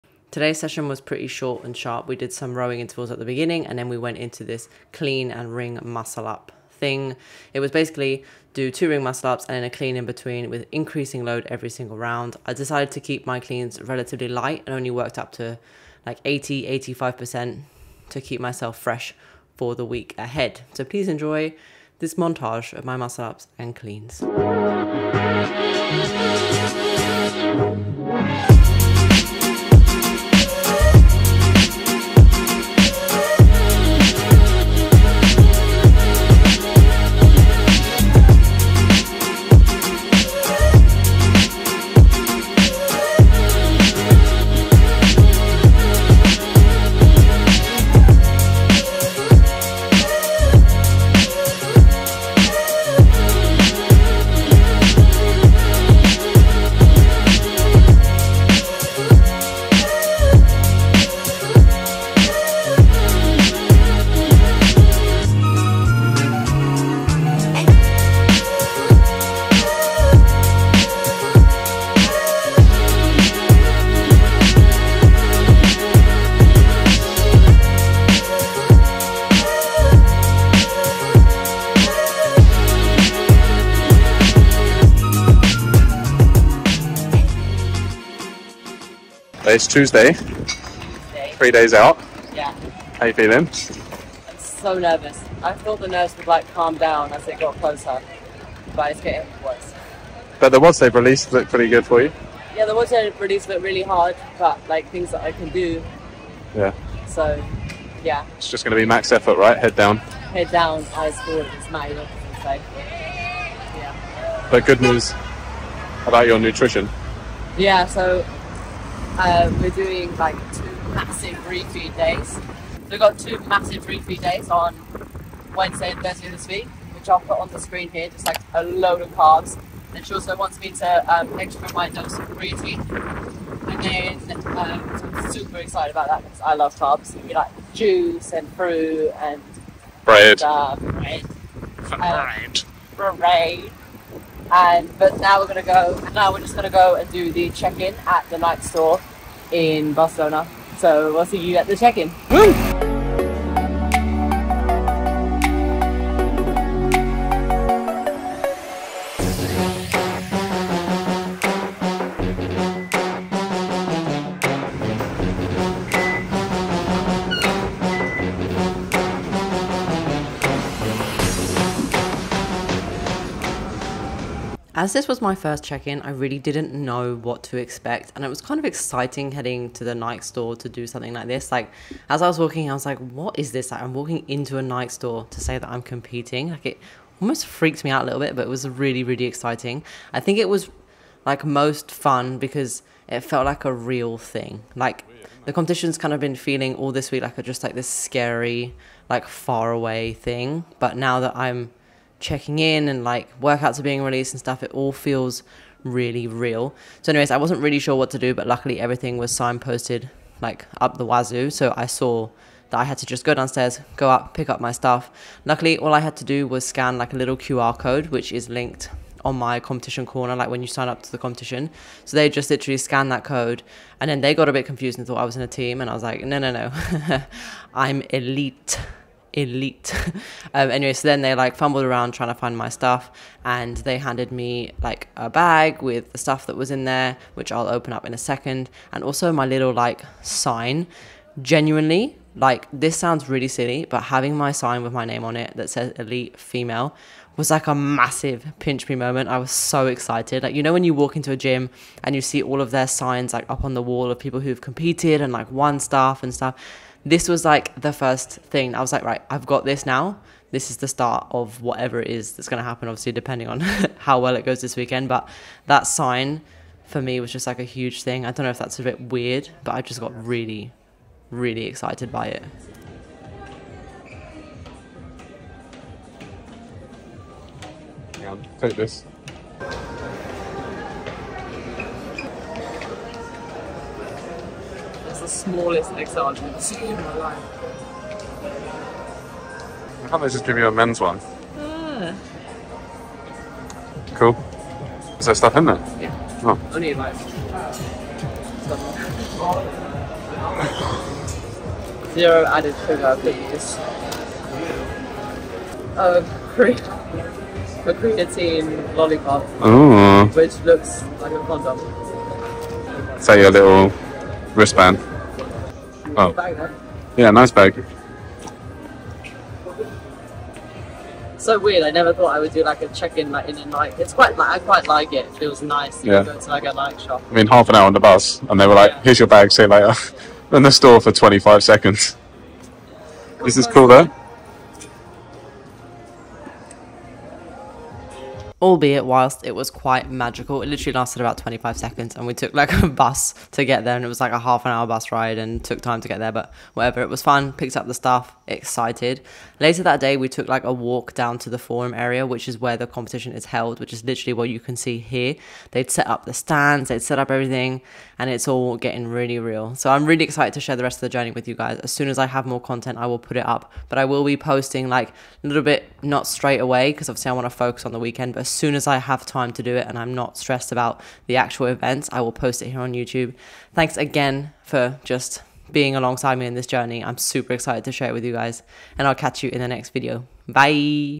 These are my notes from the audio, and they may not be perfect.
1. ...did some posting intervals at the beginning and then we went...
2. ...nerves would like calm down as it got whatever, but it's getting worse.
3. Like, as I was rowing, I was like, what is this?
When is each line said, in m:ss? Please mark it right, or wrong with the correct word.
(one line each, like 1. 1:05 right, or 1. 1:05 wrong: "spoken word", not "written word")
1. 0:02 wrong: "rowing", not "posting"
2. 1:35 wrong: "closer", not "whatever"
3. 3:01 wrong: "walking", not "rowing".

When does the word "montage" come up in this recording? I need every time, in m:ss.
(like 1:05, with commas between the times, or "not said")
0:22.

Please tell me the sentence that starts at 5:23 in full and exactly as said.
It's quite like I quite like it.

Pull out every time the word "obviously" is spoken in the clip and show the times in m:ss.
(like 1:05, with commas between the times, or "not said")
4:22, 6:07.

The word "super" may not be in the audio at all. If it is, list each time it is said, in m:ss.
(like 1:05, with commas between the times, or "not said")
2:15, 6:17.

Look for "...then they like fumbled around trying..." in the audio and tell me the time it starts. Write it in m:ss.
3:51.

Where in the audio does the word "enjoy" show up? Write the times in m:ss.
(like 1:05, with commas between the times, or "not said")
0:21.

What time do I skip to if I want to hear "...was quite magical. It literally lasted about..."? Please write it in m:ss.
5:39.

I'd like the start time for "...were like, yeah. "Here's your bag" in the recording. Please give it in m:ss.
5:28.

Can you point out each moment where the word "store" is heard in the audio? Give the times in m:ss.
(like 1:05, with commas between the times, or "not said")
2:28, 3:00, 3:04, 5:30.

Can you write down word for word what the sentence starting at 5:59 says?
So I'm really excited to share the rest of the journey with you guys.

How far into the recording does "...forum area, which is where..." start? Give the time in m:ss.
5:51.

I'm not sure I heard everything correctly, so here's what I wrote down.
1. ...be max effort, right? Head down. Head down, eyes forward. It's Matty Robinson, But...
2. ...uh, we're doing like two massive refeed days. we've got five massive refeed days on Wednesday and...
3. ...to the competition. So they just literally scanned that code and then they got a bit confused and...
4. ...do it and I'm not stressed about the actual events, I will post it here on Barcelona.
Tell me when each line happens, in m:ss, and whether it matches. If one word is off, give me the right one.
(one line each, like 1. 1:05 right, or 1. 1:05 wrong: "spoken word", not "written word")
1. 1:48 right
2. 1:59 wrong: "two", not "five"
3. 3:41 right
4. 6:09 wrong: "YouTube", not "Barcelona".